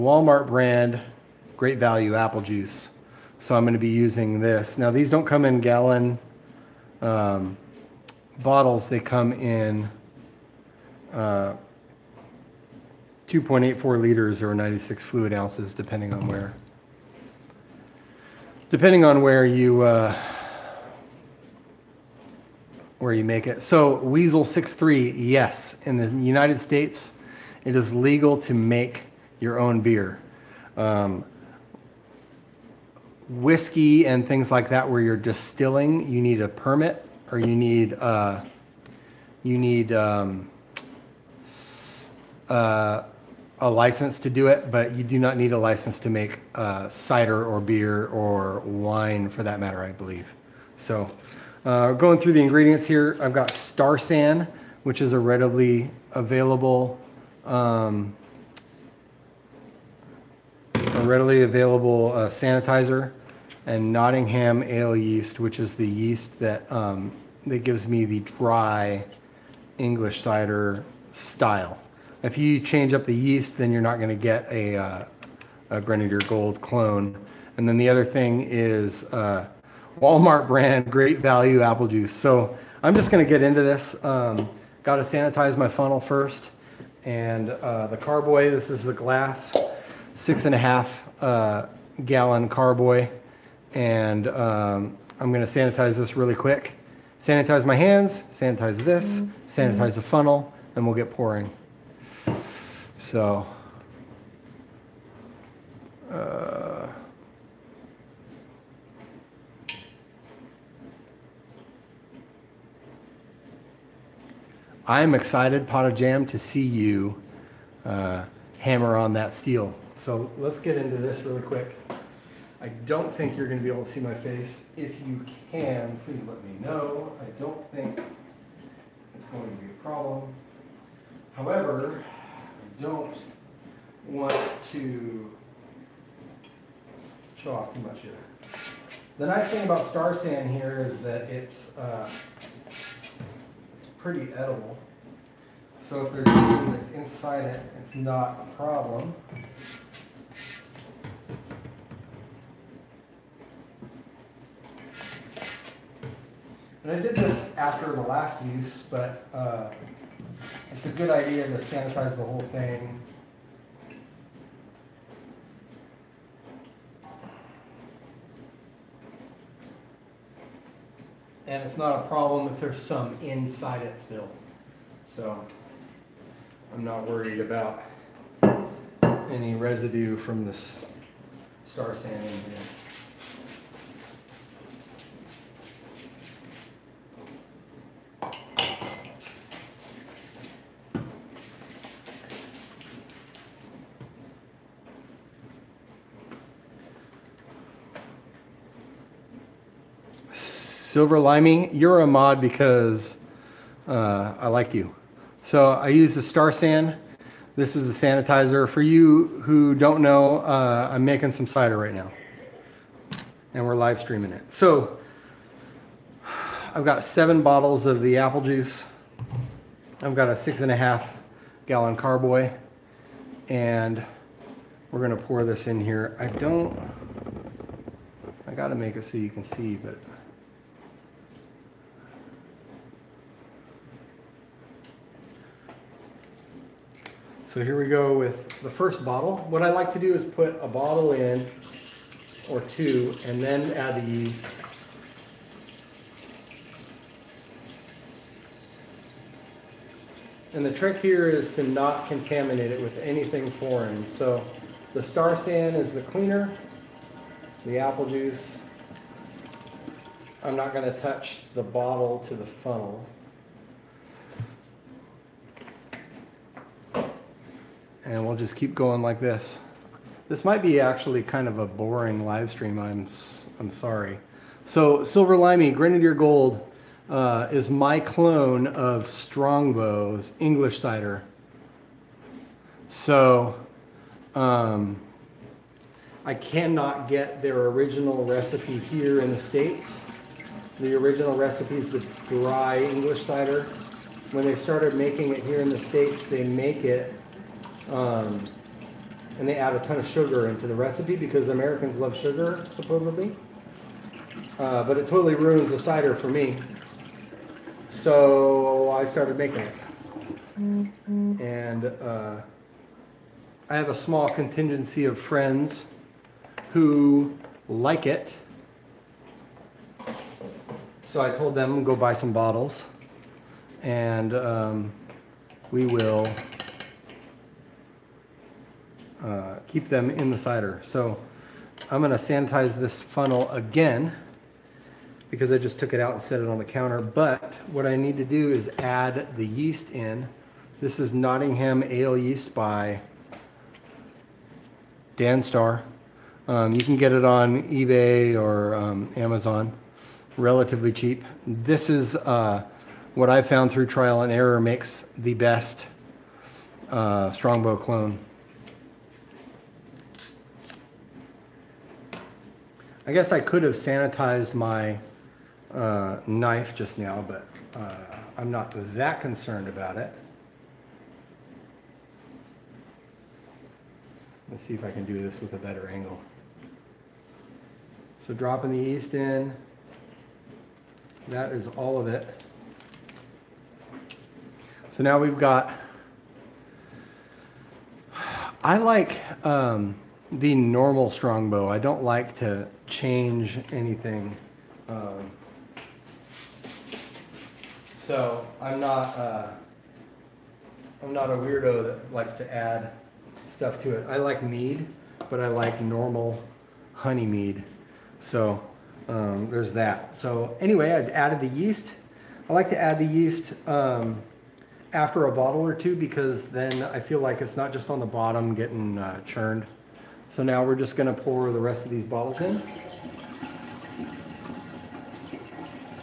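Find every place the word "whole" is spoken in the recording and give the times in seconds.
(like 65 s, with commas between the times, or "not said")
162 s.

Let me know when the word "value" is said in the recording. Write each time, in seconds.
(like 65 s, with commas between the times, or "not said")
1 s, 81 s.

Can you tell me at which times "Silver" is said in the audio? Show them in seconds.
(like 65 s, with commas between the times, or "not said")
200 s, 275 s.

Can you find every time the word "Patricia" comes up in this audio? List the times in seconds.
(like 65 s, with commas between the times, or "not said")
not said.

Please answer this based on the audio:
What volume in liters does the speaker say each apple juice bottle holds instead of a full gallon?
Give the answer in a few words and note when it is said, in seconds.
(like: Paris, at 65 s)
2.84 liters, at 13 s.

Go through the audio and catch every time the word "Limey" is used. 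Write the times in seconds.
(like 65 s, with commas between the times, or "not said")
201 s, 275 s.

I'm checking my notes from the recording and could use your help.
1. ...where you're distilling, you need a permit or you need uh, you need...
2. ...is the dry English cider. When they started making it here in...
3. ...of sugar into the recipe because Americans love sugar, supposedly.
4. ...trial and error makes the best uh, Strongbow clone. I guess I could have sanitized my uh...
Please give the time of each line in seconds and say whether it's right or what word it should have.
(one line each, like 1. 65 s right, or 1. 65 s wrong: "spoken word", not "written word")
1. 34 s right
2. 291 s right
3. 299 s right
4. 353 s right.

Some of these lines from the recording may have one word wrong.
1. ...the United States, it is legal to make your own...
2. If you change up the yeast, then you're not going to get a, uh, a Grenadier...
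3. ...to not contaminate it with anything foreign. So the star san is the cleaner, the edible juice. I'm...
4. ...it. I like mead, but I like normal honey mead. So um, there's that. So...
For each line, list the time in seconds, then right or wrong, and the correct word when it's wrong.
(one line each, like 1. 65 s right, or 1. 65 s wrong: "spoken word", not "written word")
1. 25 s right
2. 72 s right
3. 251 s wrong: "apple", not "edible"
4. 403 s right.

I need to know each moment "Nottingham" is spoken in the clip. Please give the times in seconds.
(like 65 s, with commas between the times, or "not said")
63 s, 341 s.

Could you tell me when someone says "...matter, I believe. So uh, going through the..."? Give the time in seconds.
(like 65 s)
49 s.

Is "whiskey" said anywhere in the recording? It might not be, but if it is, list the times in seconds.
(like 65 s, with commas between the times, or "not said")
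33 s.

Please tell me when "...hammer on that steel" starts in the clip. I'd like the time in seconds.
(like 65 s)
118 s.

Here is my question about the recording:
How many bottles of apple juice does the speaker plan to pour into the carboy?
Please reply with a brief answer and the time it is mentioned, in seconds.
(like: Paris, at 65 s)
7, at 217 s.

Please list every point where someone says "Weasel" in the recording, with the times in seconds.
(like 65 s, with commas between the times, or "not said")
23 s.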